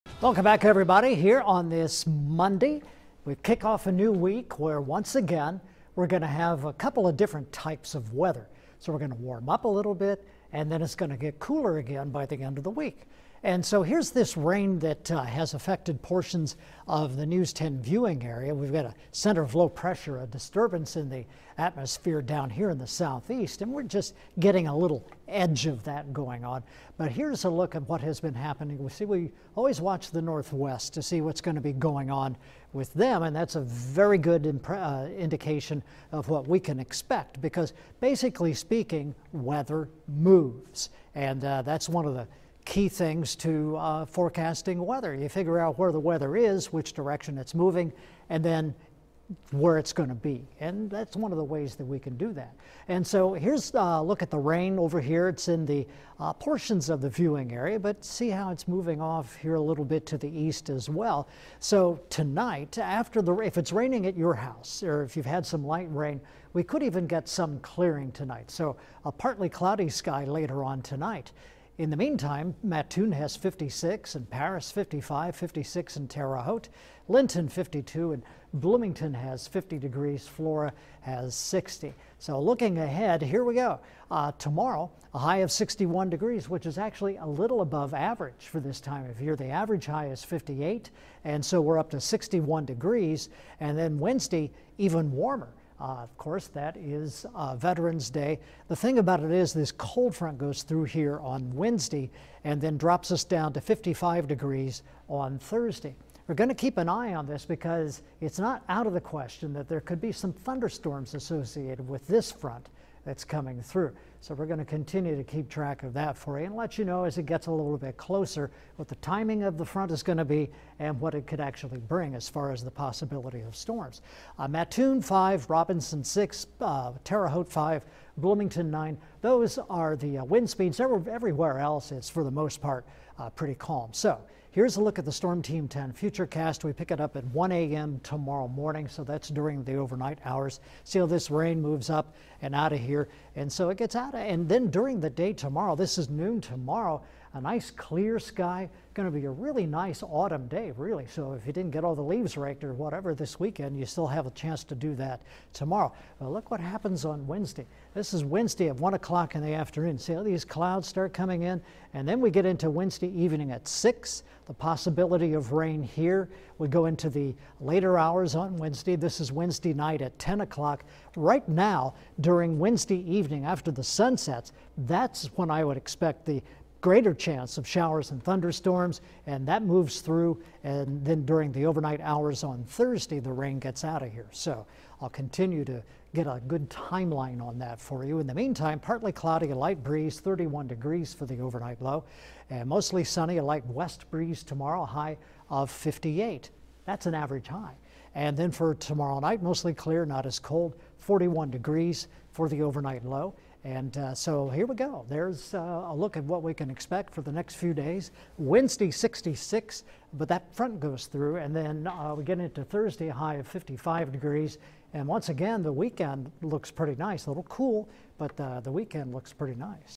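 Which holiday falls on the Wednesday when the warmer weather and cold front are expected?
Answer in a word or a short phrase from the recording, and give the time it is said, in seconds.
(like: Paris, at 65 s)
Veterans Day, at 97 s.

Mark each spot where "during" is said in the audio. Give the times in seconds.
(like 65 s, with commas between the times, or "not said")
139 s, 144 s, 172 s, 181 s.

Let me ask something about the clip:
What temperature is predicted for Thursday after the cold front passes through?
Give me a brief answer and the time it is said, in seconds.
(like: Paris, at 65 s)
55 degrees, at 102 s.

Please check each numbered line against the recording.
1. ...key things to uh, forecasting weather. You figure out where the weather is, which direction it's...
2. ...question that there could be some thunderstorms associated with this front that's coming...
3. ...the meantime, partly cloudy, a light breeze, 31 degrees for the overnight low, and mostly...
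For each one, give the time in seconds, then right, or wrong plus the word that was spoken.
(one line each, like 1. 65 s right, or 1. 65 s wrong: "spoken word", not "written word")
1. 42 s right
2. 109 s right
3. 188 s right.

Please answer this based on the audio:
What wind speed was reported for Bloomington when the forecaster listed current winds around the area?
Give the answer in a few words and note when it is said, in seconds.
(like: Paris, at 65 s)
9, at 128 s.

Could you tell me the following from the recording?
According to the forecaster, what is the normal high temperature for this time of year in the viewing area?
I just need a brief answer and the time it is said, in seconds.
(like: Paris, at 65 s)
58, at 89 s.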